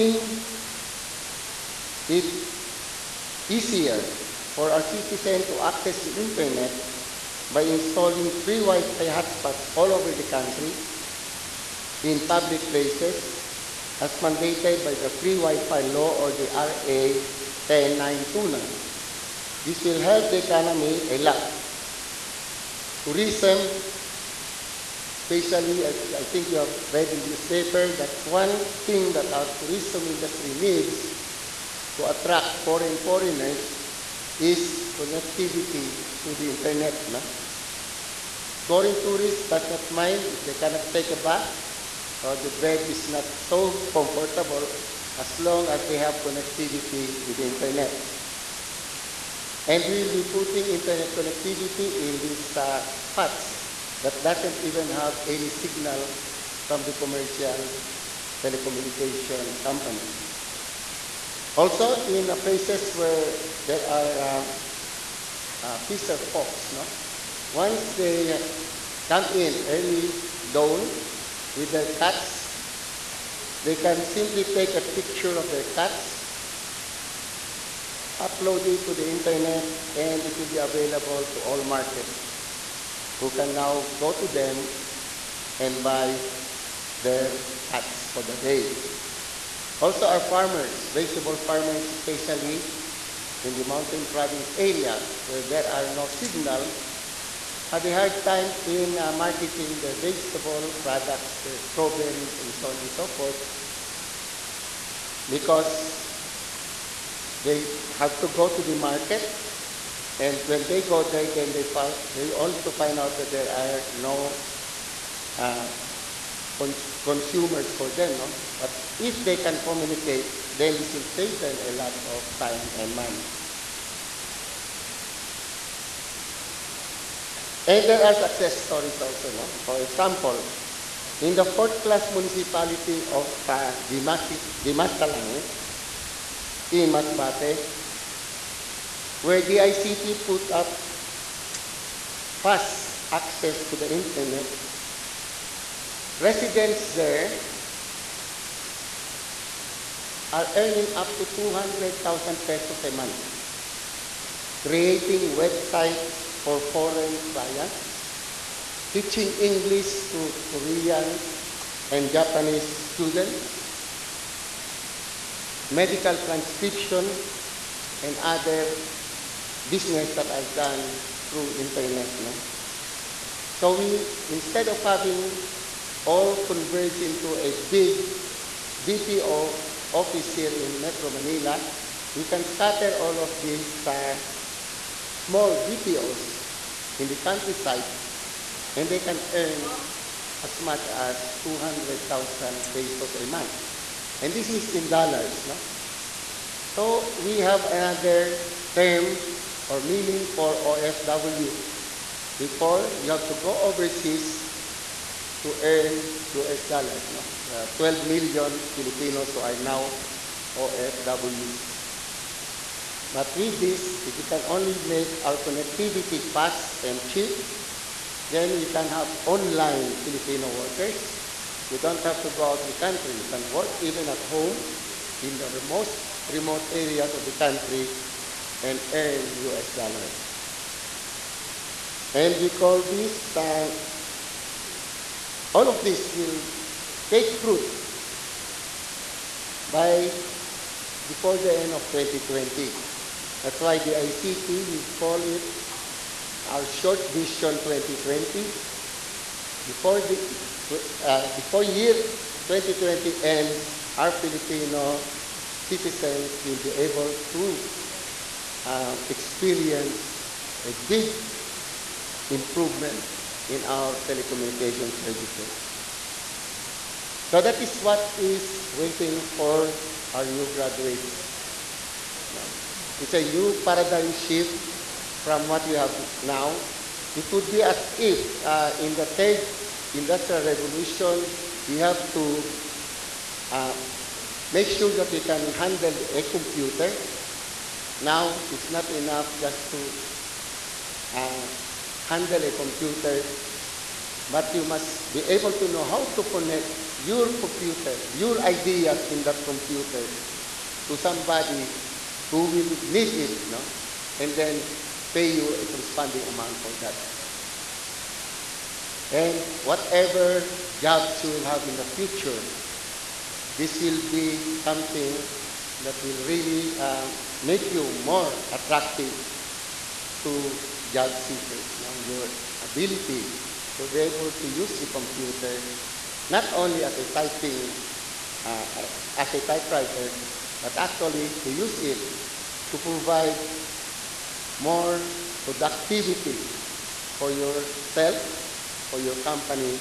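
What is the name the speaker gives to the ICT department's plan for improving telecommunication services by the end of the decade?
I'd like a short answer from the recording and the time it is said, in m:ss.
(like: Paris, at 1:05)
short vision 2020, at 4:06.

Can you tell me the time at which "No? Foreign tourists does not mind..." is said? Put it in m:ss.
0:37.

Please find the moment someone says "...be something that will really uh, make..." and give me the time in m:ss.
5:14.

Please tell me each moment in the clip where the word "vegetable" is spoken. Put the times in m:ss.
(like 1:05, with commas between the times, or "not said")
1:30, 1:39.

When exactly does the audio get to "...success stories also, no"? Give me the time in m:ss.
2:08.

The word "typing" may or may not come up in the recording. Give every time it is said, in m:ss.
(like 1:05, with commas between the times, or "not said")
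5:27.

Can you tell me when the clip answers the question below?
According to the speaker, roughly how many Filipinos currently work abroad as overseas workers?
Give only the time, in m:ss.
3:27.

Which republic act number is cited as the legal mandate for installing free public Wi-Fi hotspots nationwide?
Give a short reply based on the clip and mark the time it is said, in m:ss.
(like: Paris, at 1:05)
RA 10929, at 0:16.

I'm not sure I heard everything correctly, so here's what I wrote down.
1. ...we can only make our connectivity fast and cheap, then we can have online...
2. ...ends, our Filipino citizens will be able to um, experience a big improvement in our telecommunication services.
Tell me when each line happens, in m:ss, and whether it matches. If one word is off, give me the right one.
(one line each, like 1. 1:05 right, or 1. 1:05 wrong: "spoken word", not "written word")
1. 3:34 right
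2. 4:13 right.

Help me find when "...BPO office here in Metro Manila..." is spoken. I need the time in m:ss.
2:58.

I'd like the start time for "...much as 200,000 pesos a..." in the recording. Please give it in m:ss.
3:10.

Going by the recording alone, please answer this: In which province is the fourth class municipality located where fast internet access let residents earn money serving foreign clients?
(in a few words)
Masbate.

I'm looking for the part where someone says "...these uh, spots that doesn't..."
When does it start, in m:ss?
0:52.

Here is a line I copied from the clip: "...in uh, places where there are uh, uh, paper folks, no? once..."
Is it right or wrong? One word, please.
wrong.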